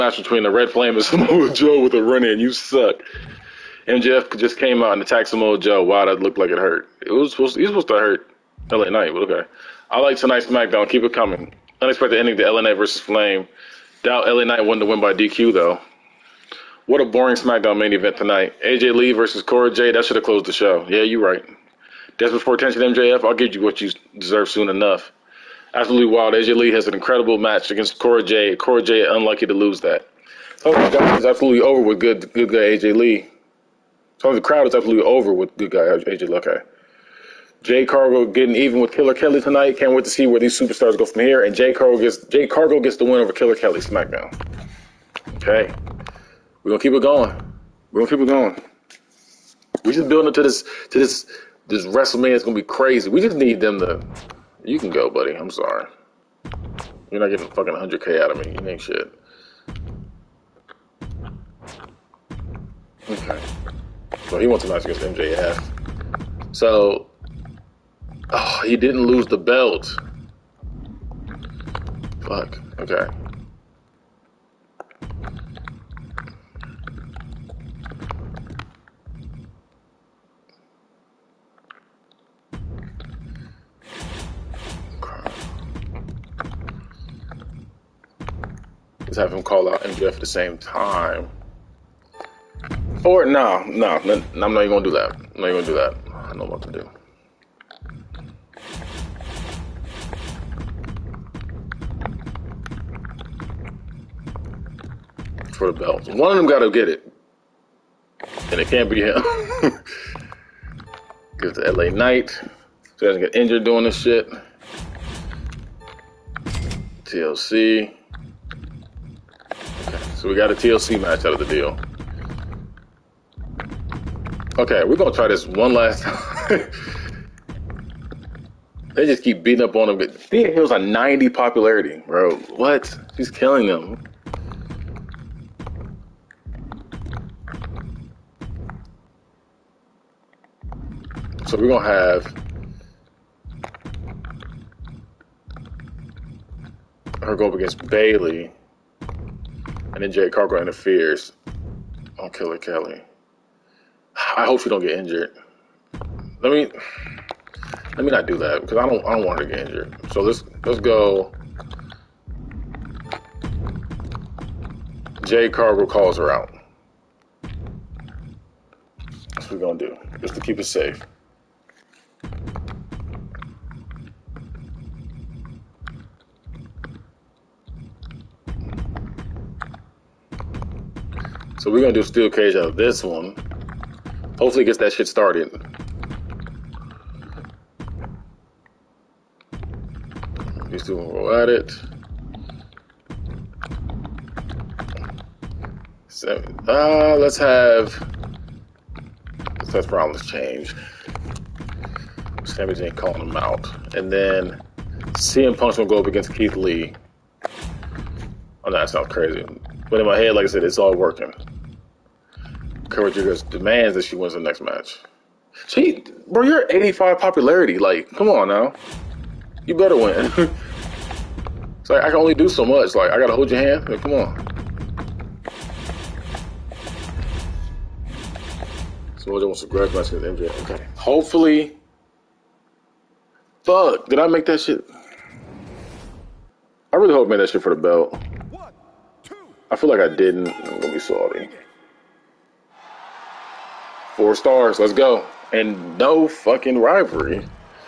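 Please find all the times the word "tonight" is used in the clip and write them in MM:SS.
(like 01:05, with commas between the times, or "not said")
00:10, 00:18, 00:39.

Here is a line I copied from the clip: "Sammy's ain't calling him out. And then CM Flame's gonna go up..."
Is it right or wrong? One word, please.
wrong.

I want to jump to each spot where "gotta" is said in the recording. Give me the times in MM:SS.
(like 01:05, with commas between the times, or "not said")
01:46, 03:43.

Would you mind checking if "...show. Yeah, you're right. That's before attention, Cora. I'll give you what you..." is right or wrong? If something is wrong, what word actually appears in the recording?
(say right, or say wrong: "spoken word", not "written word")
wrong: "MJF", not "Cora".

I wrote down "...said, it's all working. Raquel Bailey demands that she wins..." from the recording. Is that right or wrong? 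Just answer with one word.
wrong.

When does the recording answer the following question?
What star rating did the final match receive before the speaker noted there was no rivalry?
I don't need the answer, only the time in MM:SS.
04:04.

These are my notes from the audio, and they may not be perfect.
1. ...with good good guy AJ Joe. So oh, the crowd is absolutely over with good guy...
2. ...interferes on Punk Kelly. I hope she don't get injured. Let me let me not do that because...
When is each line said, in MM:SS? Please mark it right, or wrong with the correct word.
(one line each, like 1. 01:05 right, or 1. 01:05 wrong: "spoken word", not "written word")
1. 00:31 wrong: "Lee", not "Joe"
2. 02:30 wrong: "Killer", not "Punk".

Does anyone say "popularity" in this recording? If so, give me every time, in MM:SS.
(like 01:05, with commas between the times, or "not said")
02:11, 03:37.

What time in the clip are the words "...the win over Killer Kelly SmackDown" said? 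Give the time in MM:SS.
00:42.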